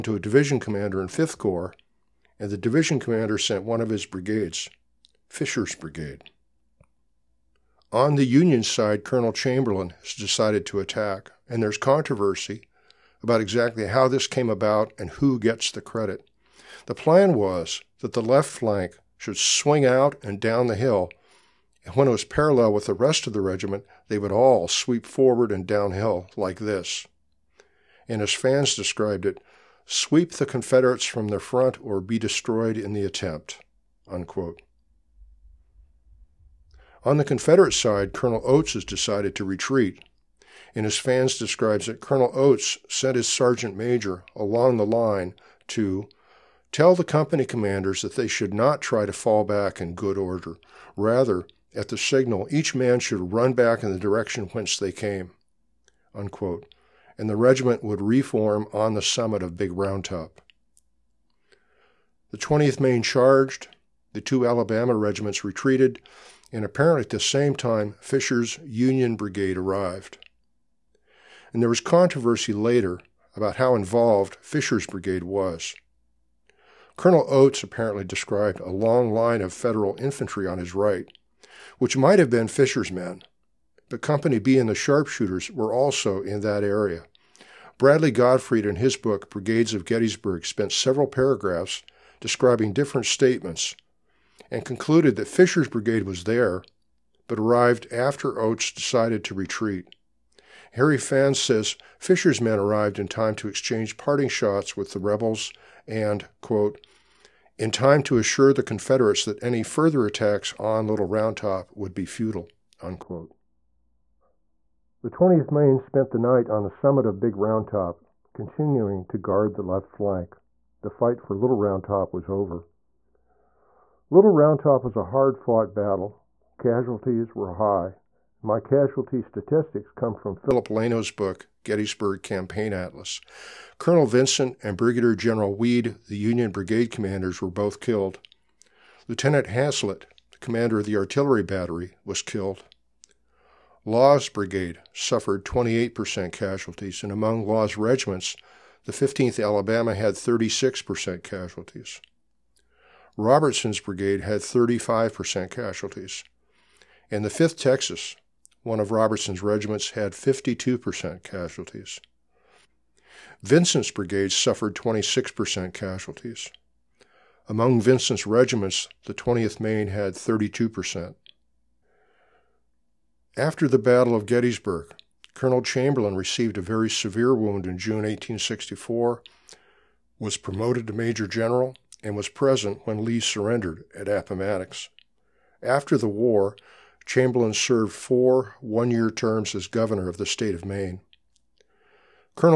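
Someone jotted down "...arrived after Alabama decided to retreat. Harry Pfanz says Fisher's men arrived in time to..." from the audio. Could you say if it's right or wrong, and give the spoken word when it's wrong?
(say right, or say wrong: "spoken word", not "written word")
wrong: "Oates", not "Alabama".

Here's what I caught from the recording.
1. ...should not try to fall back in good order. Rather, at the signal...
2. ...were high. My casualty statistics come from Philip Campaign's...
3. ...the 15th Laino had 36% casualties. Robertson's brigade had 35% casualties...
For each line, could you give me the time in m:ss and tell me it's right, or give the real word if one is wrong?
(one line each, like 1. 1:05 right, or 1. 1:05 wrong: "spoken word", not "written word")
1. 0:48 right
2. 2:07 wrong: "Laino", not "Campaign"
3. 2:28 wrong: "Alabama", not "Laino".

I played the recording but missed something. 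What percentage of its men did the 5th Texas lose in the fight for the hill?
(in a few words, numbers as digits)
52%.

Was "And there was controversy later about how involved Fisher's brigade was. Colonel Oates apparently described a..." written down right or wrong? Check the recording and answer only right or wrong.
right.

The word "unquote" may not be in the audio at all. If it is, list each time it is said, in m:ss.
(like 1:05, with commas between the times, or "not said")
0:34, 0:56, 1:52.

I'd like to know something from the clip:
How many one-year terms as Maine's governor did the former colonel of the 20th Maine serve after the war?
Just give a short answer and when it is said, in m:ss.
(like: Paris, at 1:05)
4, at 3:07.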